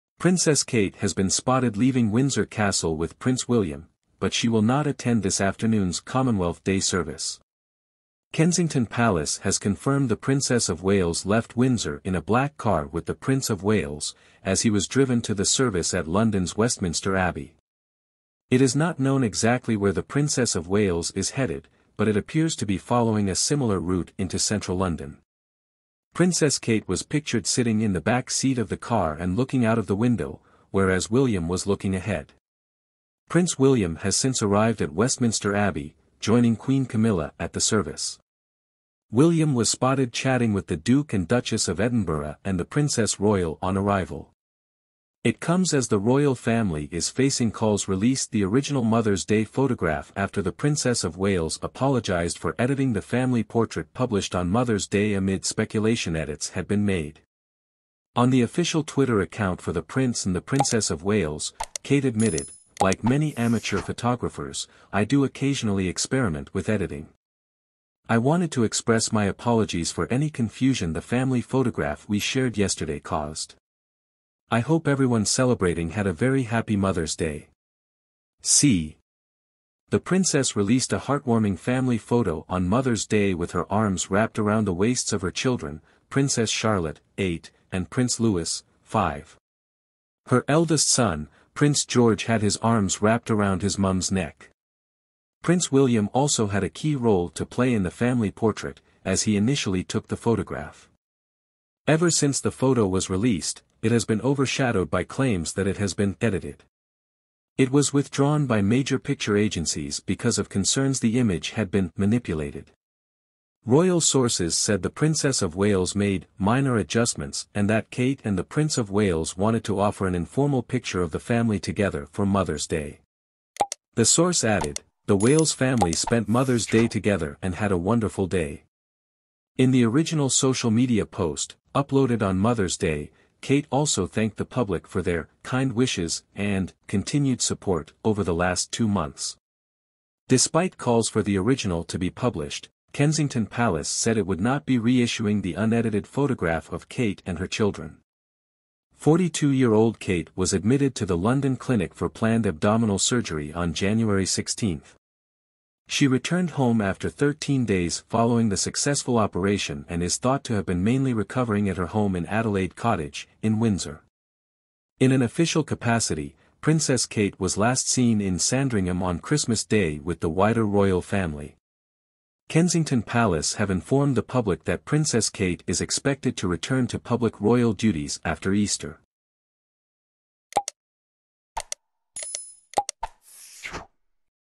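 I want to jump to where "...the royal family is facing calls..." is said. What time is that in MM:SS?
00:45.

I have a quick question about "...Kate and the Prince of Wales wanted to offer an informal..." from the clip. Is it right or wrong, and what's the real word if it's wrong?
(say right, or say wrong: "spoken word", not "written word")
right.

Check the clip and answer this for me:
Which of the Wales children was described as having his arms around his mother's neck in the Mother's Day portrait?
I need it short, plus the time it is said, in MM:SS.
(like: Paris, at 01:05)
Prince George, at 01:31.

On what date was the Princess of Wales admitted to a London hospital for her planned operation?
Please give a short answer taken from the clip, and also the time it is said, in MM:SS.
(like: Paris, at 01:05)
January 16, at 02:33.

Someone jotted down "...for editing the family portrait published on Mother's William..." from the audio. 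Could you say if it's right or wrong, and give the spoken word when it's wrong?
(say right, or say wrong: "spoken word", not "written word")
wrong: "Day", not "William".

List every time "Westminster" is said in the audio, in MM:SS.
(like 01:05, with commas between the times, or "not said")
00:16, 00:34.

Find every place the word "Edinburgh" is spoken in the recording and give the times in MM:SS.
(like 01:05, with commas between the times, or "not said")
00:41.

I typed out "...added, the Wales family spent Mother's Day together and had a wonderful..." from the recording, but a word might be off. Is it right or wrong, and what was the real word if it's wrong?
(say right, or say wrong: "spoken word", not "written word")
right.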